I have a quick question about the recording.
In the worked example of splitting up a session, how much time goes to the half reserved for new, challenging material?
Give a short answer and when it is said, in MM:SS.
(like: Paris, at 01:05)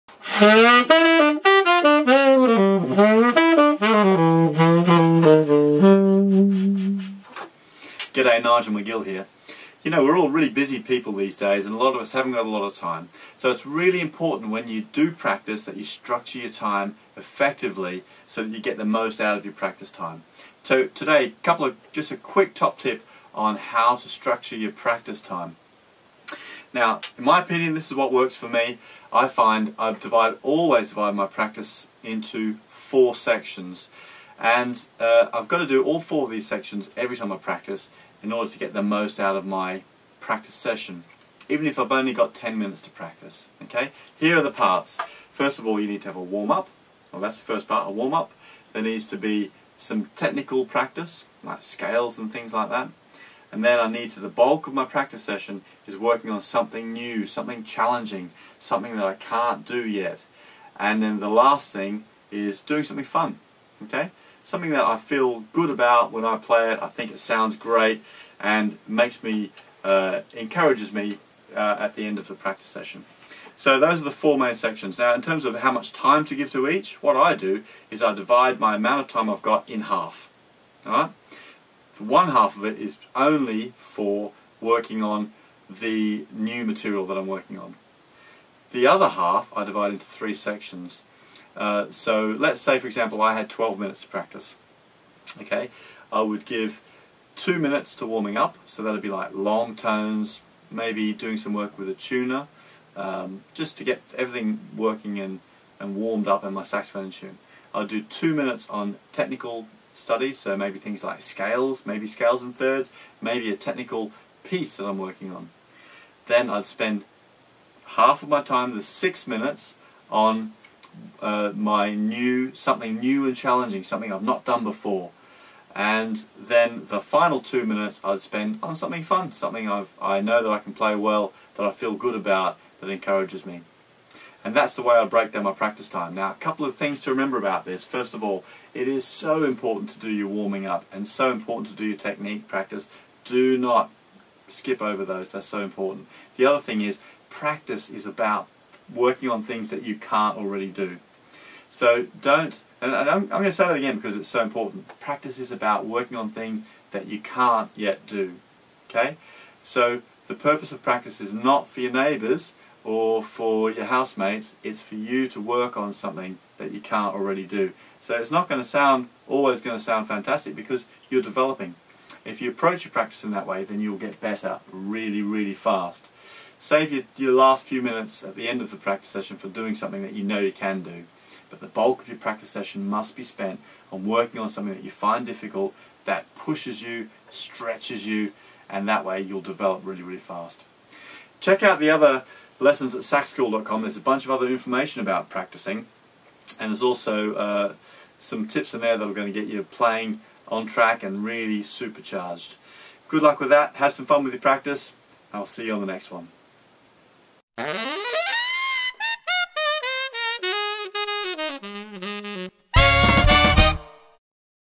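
6 minutes, at 01:58.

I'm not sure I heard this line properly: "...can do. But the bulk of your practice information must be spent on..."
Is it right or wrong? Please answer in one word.
wrong.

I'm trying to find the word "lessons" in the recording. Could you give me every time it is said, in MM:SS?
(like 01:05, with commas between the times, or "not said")
03:12.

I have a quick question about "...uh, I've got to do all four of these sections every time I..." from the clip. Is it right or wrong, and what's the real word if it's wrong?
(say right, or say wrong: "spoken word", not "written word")
right.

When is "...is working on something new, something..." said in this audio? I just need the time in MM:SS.
00:55.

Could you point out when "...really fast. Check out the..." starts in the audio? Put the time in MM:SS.
03:10.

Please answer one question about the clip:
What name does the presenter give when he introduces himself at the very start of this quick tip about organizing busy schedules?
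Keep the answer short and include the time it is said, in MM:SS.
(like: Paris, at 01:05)
Nigel McGill, at 00:08.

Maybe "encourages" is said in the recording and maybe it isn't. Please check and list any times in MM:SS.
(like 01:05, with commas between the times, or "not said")
01:10, 02:12.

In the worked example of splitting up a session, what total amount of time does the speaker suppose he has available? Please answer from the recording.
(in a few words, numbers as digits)
12 minutes.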